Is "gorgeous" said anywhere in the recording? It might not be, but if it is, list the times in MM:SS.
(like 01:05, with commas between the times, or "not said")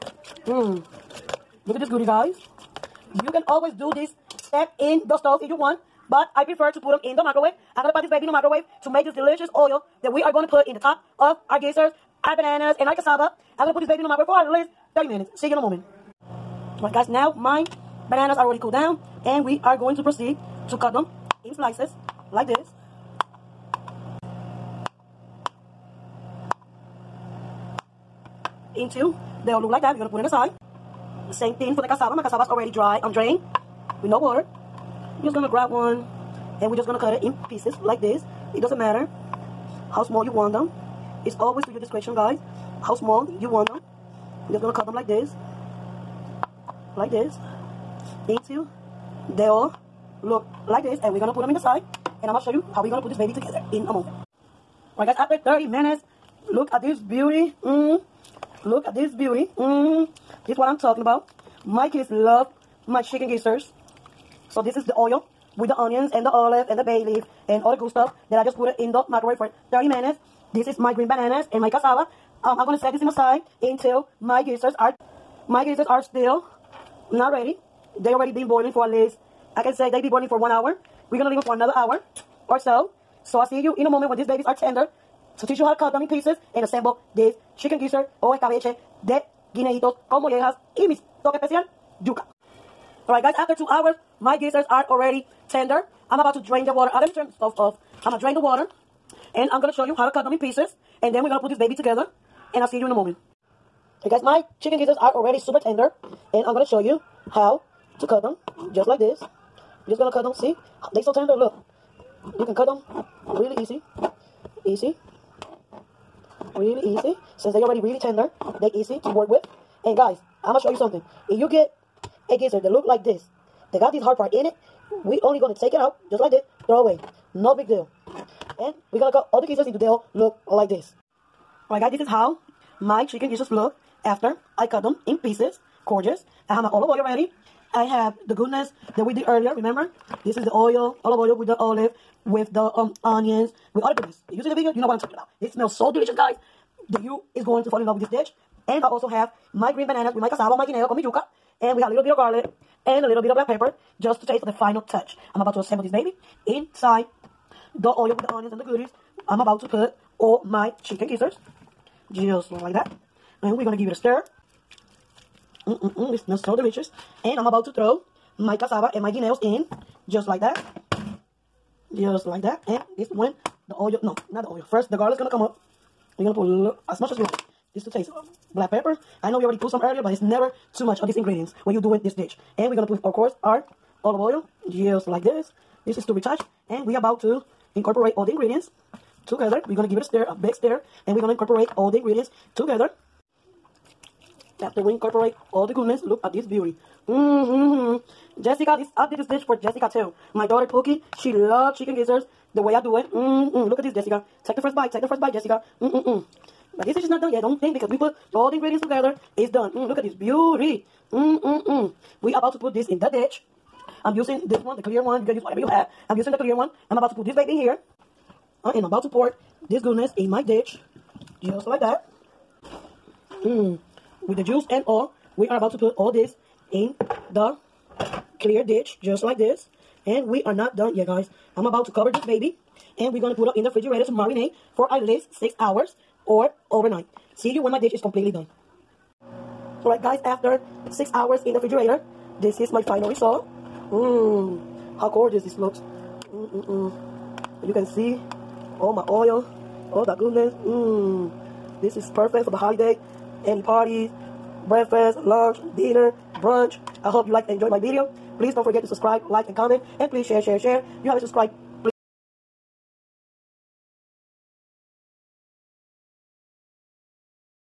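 02:15, 04:05.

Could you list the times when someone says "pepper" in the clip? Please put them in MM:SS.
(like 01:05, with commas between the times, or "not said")
02:33, 02:58.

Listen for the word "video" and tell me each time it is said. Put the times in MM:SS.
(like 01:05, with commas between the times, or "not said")
02:24, 04:17.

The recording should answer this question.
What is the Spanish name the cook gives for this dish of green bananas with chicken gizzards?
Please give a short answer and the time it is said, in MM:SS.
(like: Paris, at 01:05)
escabeche de guineitos con mollejas, at 01:28.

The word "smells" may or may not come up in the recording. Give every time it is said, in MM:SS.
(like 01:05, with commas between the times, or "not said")
02:25, 02:46.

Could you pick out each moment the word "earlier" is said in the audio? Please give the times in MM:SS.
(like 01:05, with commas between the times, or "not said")
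02:19, 02:59.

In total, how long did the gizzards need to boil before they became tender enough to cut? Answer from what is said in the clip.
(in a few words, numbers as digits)
2 hours.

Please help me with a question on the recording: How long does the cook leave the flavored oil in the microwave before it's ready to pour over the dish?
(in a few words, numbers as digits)
30 minutes.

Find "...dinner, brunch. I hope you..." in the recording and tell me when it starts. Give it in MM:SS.
04:15.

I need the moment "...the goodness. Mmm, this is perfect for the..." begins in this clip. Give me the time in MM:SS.
04:10.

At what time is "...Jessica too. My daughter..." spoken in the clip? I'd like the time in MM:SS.
03:19.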